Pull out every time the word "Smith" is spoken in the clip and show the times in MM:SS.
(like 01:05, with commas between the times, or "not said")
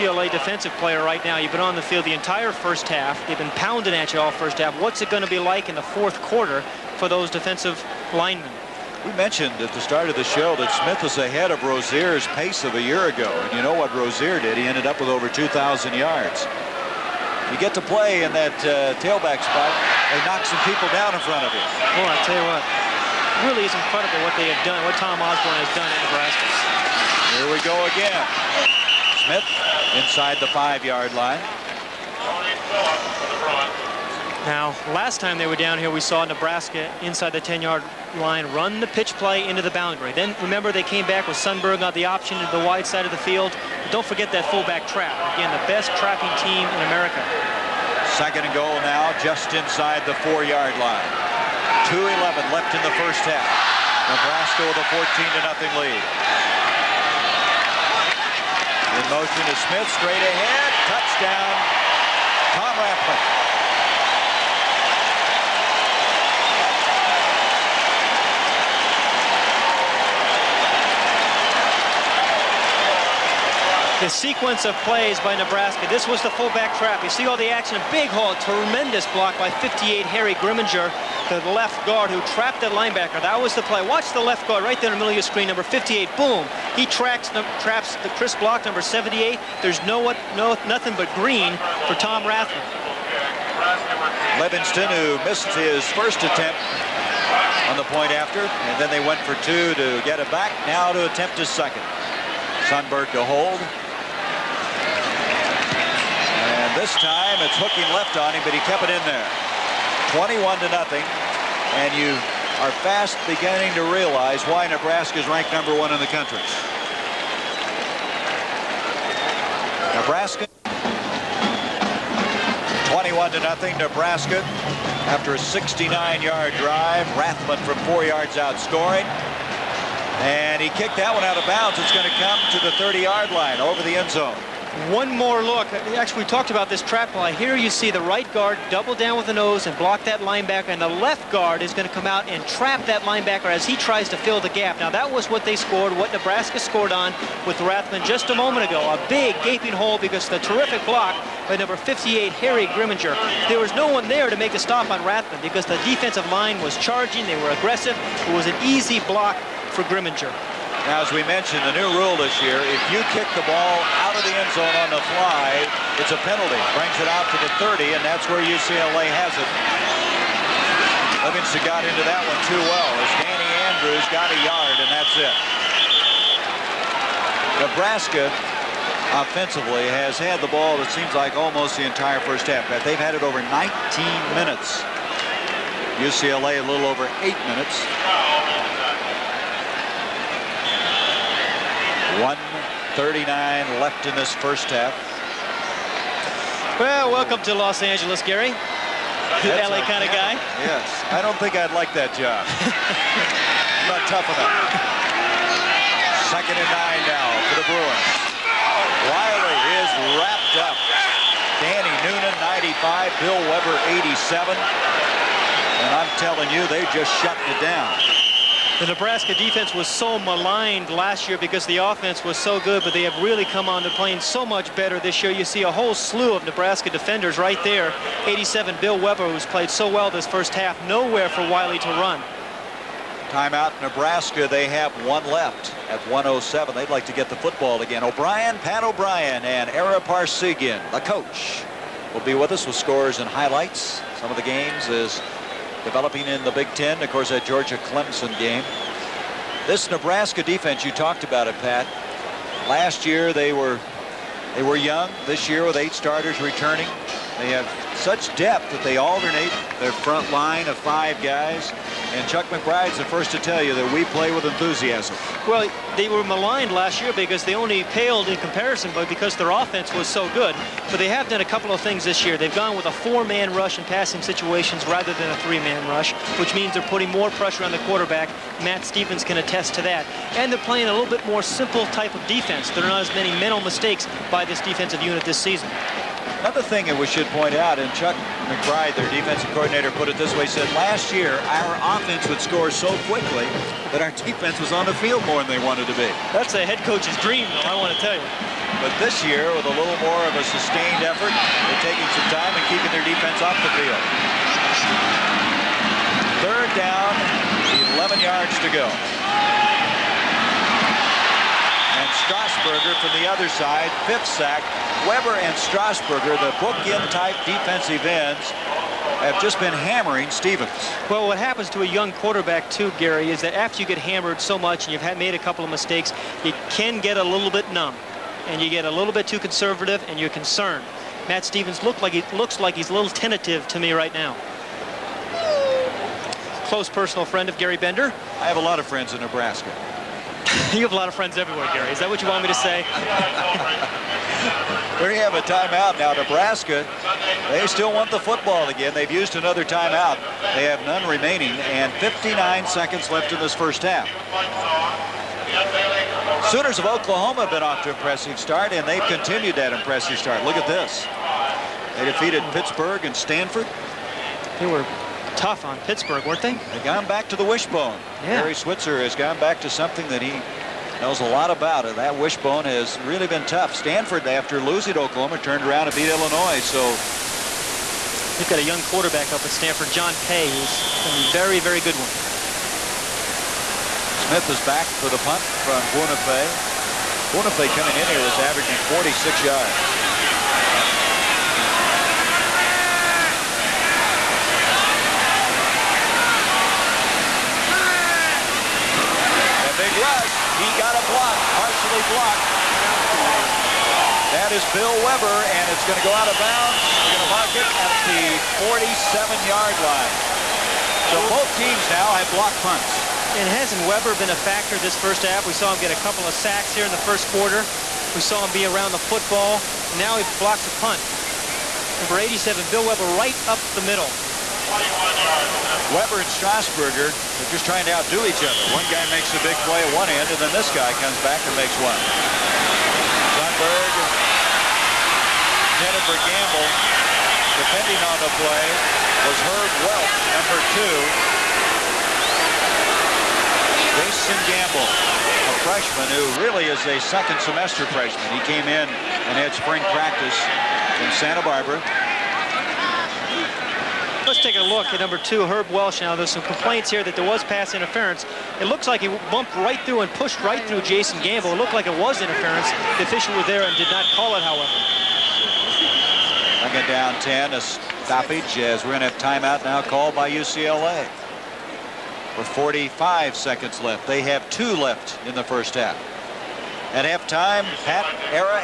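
00:10, 00:29, 00:59, 06:24.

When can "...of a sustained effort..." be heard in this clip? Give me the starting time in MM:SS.
05:00.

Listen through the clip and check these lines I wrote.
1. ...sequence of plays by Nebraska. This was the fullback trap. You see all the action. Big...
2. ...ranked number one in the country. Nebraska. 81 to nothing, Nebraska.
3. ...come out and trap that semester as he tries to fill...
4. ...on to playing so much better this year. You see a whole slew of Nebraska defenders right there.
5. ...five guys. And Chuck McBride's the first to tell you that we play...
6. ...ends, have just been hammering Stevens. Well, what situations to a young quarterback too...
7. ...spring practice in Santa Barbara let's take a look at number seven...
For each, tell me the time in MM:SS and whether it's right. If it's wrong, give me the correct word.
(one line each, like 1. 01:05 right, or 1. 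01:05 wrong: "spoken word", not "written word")
1. 01:14 right
2. 01:55 wrong: "21", not "81"
3. 02:21 wrong: "linebacker", not "semester"
4. 03:43 right
5. 04:20 right
6. 05:18 wrong: "happens", not "situations"
7. 07:29 wrong: "two", not "seven".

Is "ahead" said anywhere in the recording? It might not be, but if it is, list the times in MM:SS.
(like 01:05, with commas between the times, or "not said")
00:11, 01:00.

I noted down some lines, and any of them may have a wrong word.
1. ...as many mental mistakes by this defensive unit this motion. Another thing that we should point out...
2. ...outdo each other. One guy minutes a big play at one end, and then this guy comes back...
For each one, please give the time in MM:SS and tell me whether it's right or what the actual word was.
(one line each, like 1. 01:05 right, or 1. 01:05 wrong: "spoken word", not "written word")
1. 04:43 wrong: "season", not "motion"
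2. 07:07 wrong: "makes", not "minutes".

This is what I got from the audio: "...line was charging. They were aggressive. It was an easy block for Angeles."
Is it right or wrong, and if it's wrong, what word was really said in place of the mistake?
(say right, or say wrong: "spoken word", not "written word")
wrong: "Grimminger", not "Angeles".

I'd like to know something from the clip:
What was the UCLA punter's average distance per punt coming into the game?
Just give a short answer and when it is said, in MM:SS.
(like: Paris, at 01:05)
46 yards, at 06:28.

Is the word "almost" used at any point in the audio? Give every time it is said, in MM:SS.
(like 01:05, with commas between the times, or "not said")
03:01.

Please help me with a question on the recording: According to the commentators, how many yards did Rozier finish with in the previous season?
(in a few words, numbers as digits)
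over 2,000.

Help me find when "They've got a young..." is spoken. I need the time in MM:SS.
06:18.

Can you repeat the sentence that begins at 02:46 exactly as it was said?
Brings it out to the 30, and that's where UCLA has it.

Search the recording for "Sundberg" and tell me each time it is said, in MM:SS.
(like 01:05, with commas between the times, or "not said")
00:41, 01:42, 07:13.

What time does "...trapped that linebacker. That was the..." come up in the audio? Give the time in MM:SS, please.
01:22.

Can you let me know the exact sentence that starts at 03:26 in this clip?
Second and nine now for the Bruins.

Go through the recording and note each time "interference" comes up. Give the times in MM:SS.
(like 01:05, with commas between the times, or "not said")
07:37, 07:42.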